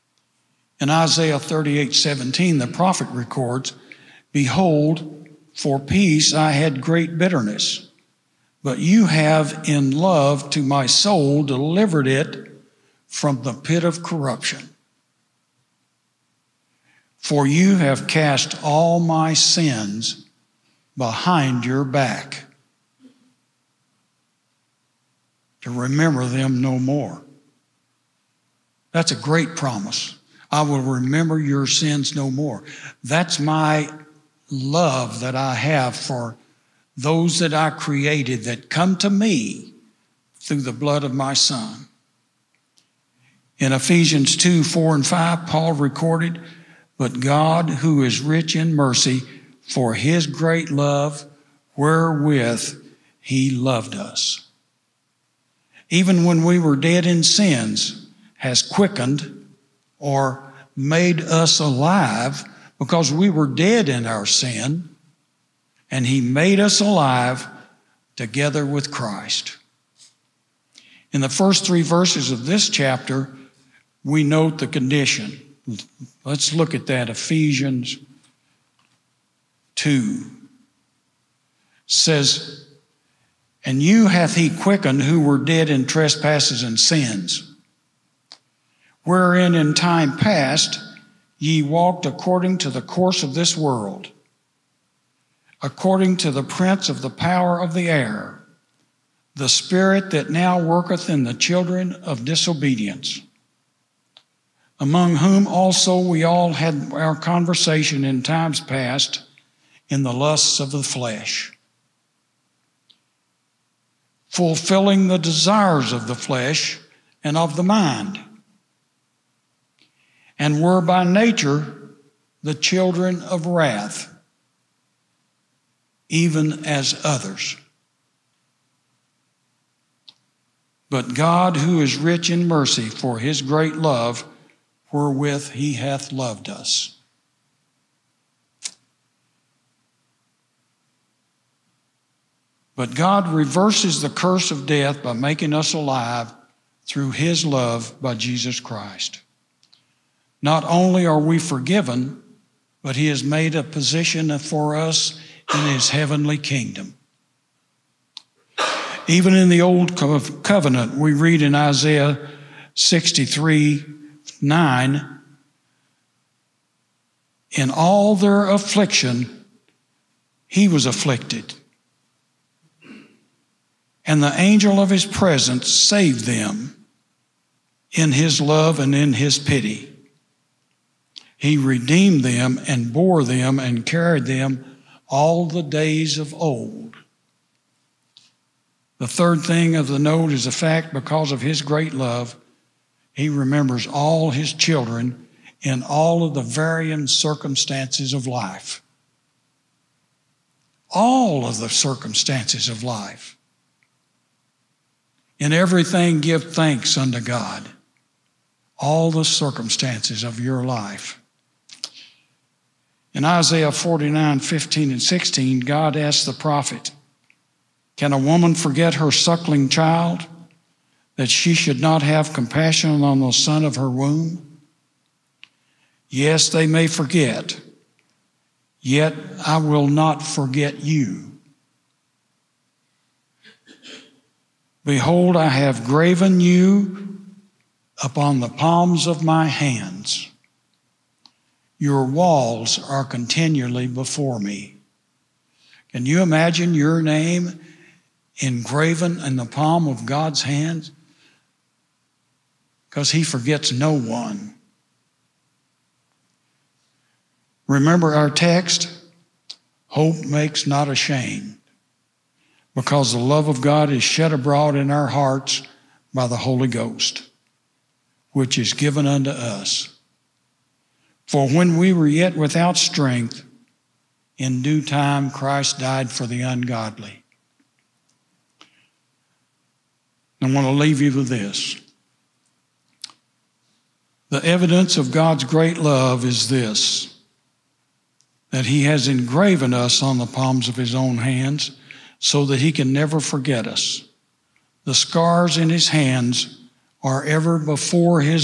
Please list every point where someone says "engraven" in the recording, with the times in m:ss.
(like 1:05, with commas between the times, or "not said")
4:08, 4:49.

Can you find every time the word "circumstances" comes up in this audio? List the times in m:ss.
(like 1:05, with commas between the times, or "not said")
3:17, 3:21, 3:29.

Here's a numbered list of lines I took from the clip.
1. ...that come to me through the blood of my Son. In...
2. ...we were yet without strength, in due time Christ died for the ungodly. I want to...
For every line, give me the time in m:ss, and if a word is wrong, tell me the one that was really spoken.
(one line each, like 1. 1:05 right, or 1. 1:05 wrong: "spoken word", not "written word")
1. 0:38 right
2. 4:31 right.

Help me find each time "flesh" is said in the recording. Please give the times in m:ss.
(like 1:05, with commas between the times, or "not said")
1:50, 1:56.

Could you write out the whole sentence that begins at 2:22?
But God reverses the curse of death by making us alive through his love by Jesus Christ.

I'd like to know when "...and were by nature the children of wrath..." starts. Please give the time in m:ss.
2:00.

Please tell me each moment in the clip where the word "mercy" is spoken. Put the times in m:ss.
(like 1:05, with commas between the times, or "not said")
0:48, 2:12.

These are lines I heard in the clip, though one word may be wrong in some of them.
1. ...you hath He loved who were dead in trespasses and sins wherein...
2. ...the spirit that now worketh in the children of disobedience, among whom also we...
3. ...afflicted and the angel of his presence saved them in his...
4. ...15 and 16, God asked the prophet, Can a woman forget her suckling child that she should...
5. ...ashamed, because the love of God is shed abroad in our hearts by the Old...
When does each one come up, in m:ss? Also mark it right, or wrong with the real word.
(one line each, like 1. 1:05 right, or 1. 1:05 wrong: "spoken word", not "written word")
1. 1:23 wrong: "quickened", not "loved"
2. 1:39 right
3. 2:50 right
4. 3:34 right
5. 4:20 wrong: "Holy", not "Old".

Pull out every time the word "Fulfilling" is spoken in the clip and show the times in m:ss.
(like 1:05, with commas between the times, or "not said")
1:54.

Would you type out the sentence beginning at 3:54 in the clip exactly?
Behold, I have graven you upon the palms of my hands.